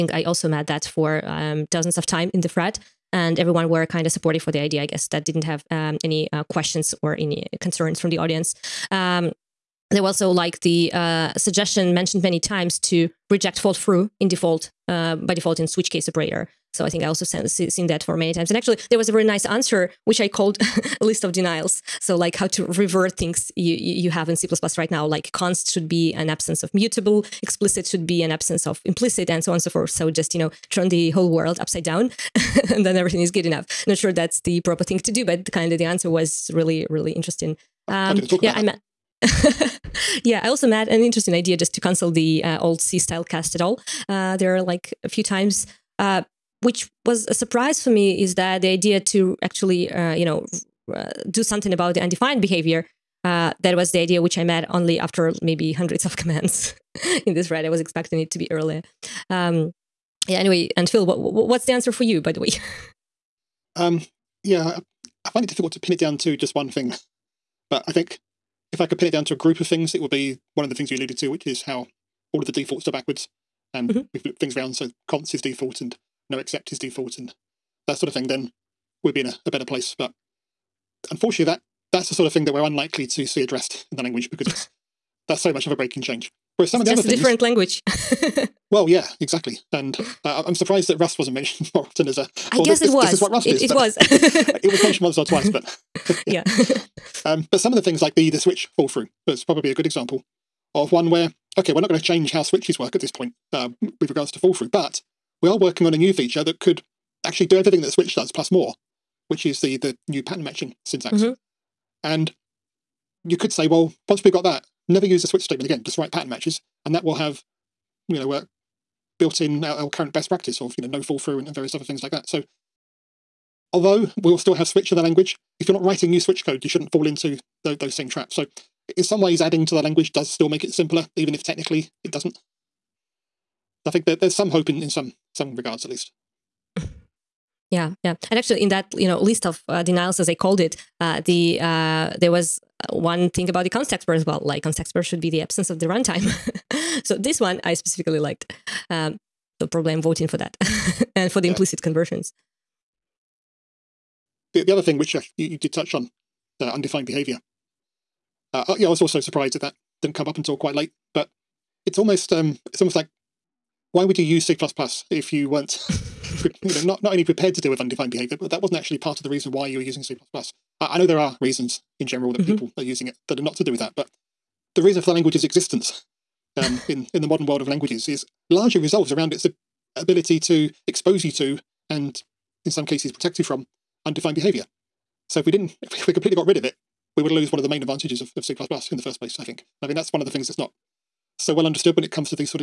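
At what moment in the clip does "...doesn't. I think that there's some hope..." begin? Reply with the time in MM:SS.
02:12.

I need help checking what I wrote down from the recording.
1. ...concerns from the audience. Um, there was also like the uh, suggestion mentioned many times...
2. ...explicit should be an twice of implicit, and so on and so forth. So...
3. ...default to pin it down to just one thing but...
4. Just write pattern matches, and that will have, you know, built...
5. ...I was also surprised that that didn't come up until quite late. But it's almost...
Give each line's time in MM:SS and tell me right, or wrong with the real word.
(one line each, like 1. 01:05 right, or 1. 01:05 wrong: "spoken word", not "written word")
1. 00:07 right
2. 00:27 wrong: "absence", not "twice"
3. 01:05 wrong: "difficult", not "default"
4. 01:55 right
5. 02:38 right.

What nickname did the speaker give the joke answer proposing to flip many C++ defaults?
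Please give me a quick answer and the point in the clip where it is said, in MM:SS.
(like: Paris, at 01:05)
list of denials, at 00:21.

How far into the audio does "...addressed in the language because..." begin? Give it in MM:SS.
01:23.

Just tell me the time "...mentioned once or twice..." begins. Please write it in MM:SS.
01:34.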